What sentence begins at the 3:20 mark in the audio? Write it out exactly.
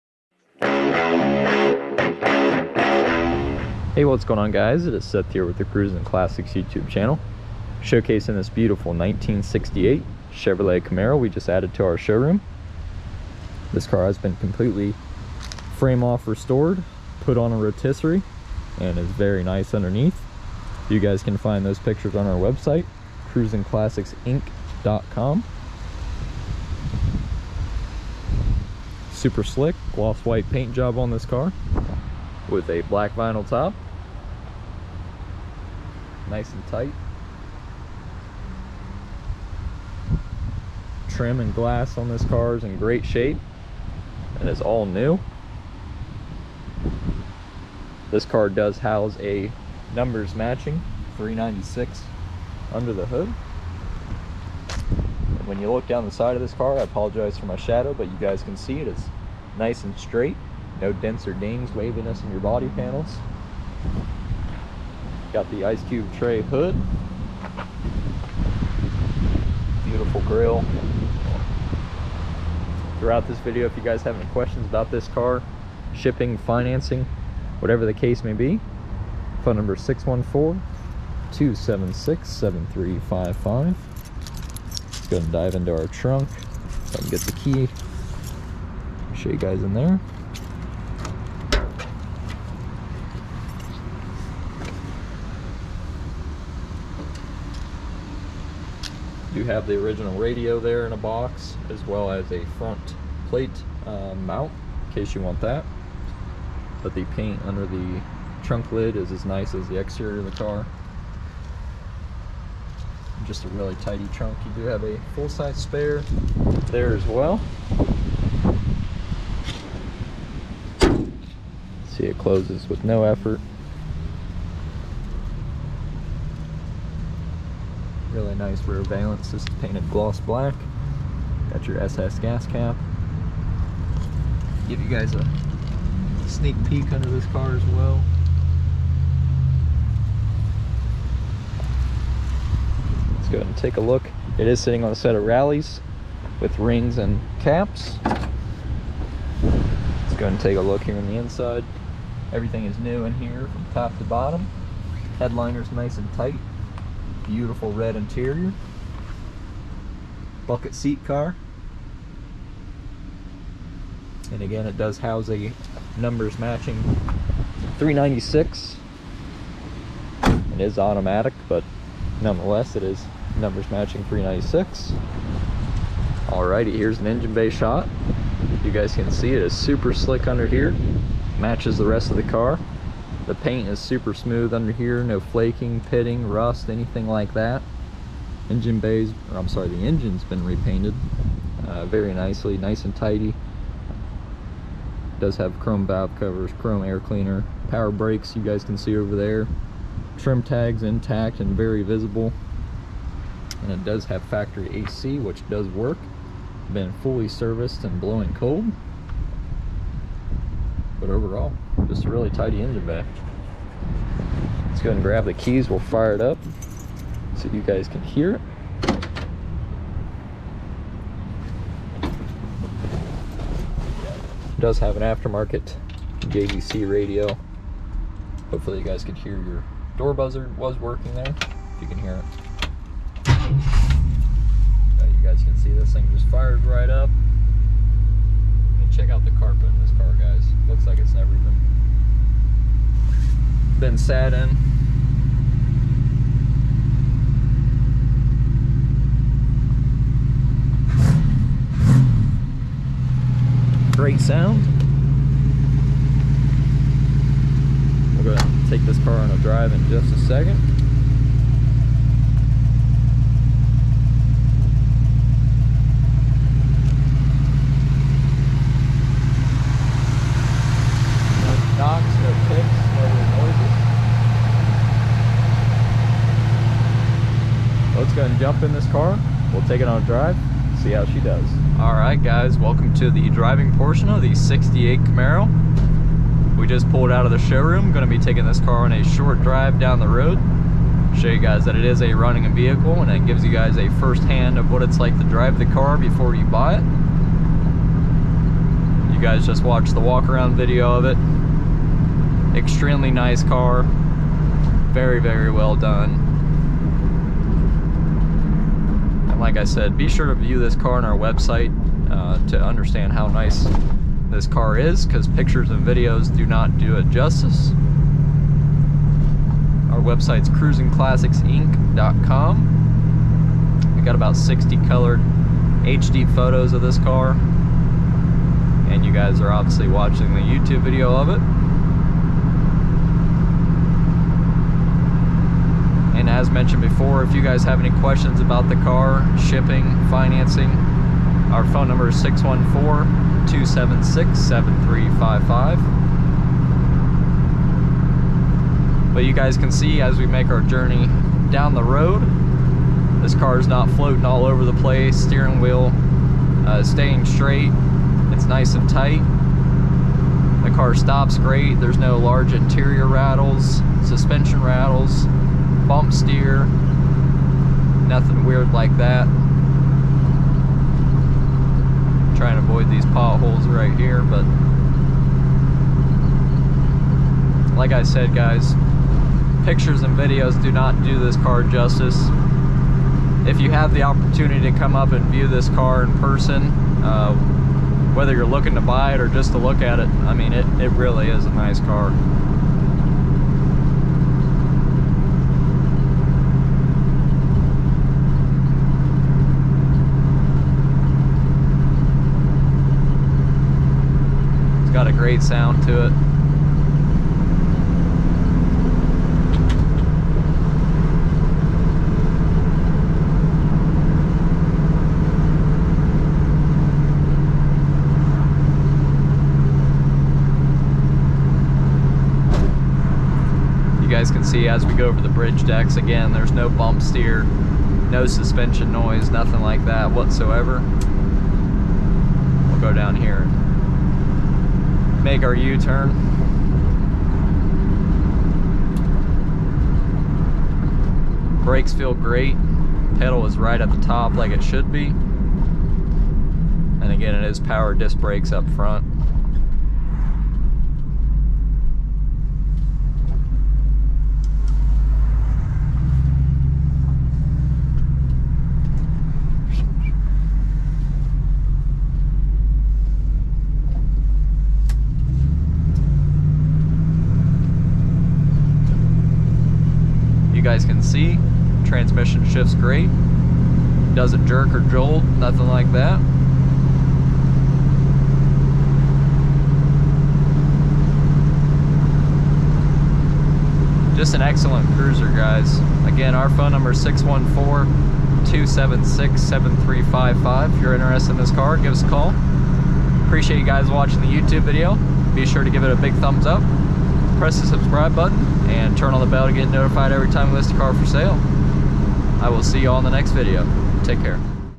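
Trim tags intact and very visible.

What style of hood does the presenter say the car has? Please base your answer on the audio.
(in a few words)
Ice Cube tray hood.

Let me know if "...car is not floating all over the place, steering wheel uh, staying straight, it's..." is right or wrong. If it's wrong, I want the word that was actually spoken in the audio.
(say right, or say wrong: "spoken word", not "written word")
right.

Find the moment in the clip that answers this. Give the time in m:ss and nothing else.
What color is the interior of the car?
2:37.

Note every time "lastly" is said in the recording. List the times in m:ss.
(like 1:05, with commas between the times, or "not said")
not said.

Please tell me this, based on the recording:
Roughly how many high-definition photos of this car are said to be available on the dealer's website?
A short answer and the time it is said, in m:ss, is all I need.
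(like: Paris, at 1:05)
60, at 5:24.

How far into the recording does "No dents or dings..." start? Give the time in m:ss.
1:00.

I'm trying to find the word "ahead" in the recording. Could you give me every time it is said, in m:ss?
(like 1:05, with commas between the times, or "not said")
2:23, 2:30, 4:18.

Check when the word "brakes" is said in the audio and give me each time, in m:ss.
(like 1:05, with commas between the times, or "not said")
3:17, 7:21, 7:28.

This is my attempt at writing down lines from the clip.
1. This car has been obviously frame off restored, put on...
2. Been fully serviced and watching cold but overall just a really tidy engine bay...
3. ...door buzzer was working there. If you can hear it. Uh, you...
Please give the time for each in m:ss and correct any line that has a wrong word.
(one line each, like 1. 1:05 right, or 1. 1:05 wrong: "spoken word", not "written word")
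1. 0:13 wrong: "completely", not "obviously"
2. 3:26 wrong: "blowing", not "watching"
3. 3:49 right.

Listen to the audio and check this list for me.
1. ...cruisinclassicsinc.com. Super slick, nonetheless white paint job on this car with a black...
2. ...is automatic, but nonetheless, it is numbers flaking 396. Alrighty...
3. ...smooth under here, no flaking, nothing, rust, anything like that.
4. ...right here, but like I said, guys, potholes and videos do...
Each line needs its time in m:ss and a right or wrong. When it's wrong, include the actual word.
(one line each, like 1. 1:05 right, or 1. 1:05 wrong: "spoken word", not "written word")
1. 0:23 wrong: "gloss", not "nonetheless"
2. 2:50 wrong: "matching", not "flaking"
3. 3:04 wrong: "pitting", not "nothing"
4. 6:13 wrong: "pictures", not "potholes".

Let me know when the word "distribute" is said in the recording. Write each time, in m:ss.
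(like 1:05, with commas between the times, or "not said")
not said.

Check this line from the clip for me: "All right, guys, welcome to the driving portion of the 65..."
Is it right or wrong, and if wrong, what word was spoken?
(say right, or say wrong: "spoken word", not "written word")
wrong: "68", not "65".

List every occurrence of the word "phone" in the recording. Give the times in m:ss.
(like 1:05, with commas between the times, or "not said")
1:19, 5:41, 8:06.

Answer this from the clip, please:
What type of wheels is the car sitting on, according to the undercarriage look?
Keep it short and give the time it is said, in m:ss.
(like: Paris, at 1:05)
Rallies with rings and caps, at 2:25.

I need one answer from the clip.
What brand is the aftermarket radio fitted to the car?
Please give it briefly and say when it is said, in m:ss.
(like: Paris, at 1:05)
JVC, at 3:46.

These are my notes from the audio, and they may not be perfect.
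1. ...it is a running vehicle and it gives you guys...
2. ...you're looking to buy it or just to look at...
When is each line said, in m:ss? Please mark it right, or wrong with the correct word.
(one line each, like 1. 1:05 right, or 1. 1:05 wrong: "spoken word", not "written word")
1. 4:51 right
2. 6:28 right.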